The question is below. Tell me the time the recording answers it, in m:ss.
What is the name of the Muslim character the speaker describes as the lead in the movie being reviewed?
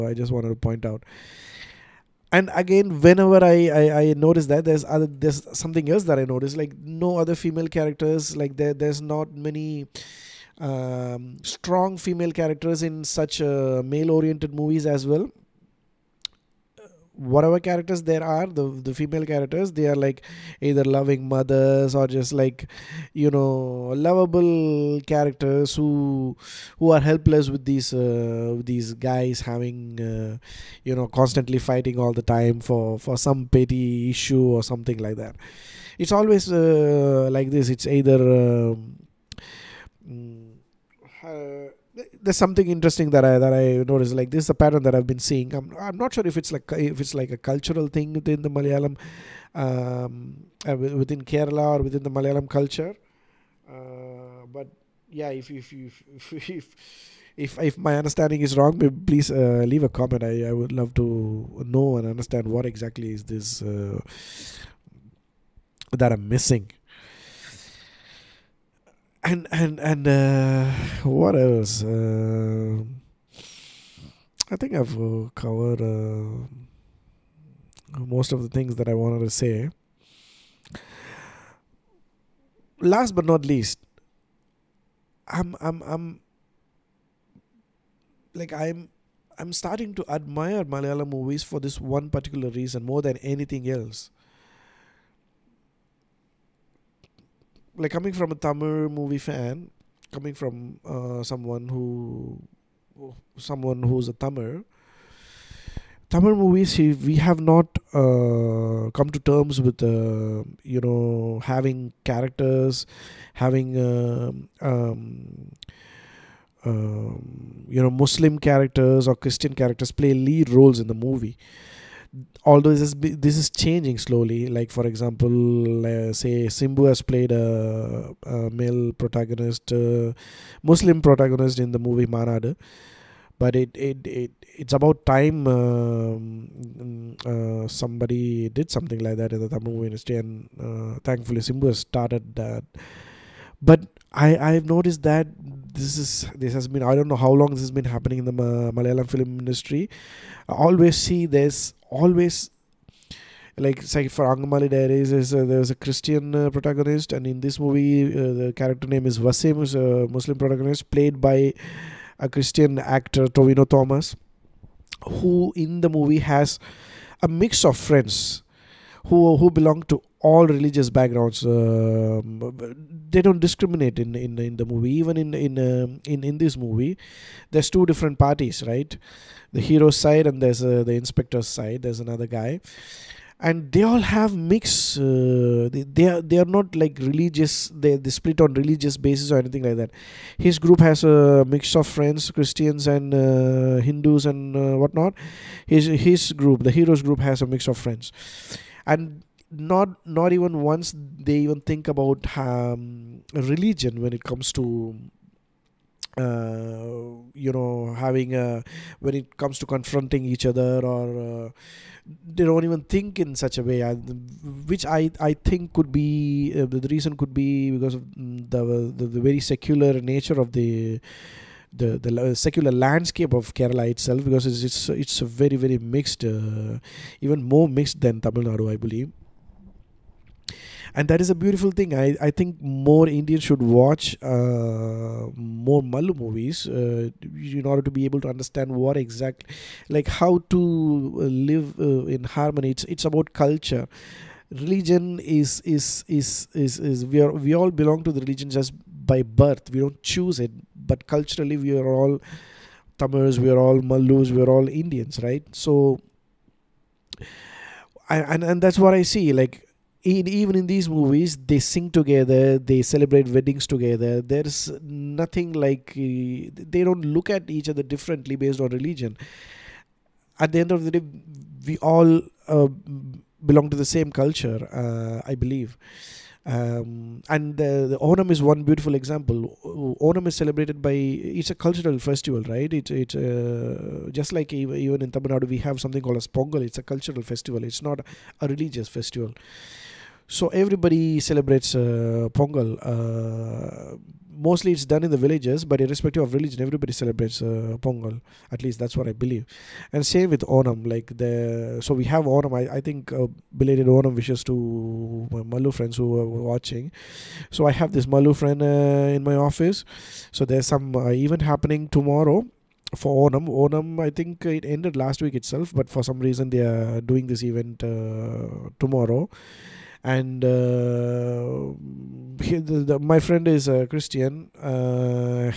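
2:39.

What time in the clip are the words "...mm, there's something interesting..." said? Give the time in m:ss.
0:40.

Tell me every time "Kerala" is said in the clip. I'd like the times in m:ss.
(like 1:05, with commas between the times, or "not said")
0:51, 3:43.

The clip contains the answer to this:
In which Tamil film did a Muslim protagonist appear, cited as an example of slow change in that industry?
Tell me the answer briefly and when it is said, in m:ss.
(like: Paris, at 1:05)
Maanaadu, at 2:12.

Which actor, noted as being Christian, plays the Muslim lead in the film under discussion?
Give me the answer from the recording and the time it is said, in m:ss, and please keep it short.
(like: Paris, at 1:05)
Tovino Thomas, at 2:43.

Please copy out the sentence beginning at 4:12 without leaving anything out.
Tamils, we are all Malus, we are all Indians, right?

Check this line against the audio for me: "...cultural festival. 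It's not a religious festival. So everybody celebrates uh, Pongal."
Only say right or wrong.
right.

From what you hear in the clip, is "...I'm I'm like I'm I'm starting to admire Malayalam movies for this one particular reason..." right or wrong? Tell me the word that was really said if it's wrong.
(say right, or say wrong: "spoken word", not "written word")
right.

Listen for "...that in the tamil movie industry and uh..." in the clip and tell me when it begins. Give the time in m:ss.
2:19.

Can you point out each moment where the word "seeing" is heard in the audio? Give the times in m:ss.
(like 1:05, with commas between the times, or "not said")
0:45.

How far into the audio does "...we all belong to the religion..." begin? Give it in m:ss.
4:07.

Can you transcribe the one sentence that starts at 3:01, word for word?
There's another guy, and they all have mix.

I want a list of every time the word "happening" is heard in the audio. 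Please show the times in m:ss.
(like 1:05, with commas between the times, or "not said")
2:27, 5:11.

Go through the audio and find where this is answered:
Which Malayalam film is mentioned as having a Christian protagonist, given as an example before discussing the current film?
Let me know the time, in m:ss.
2:34.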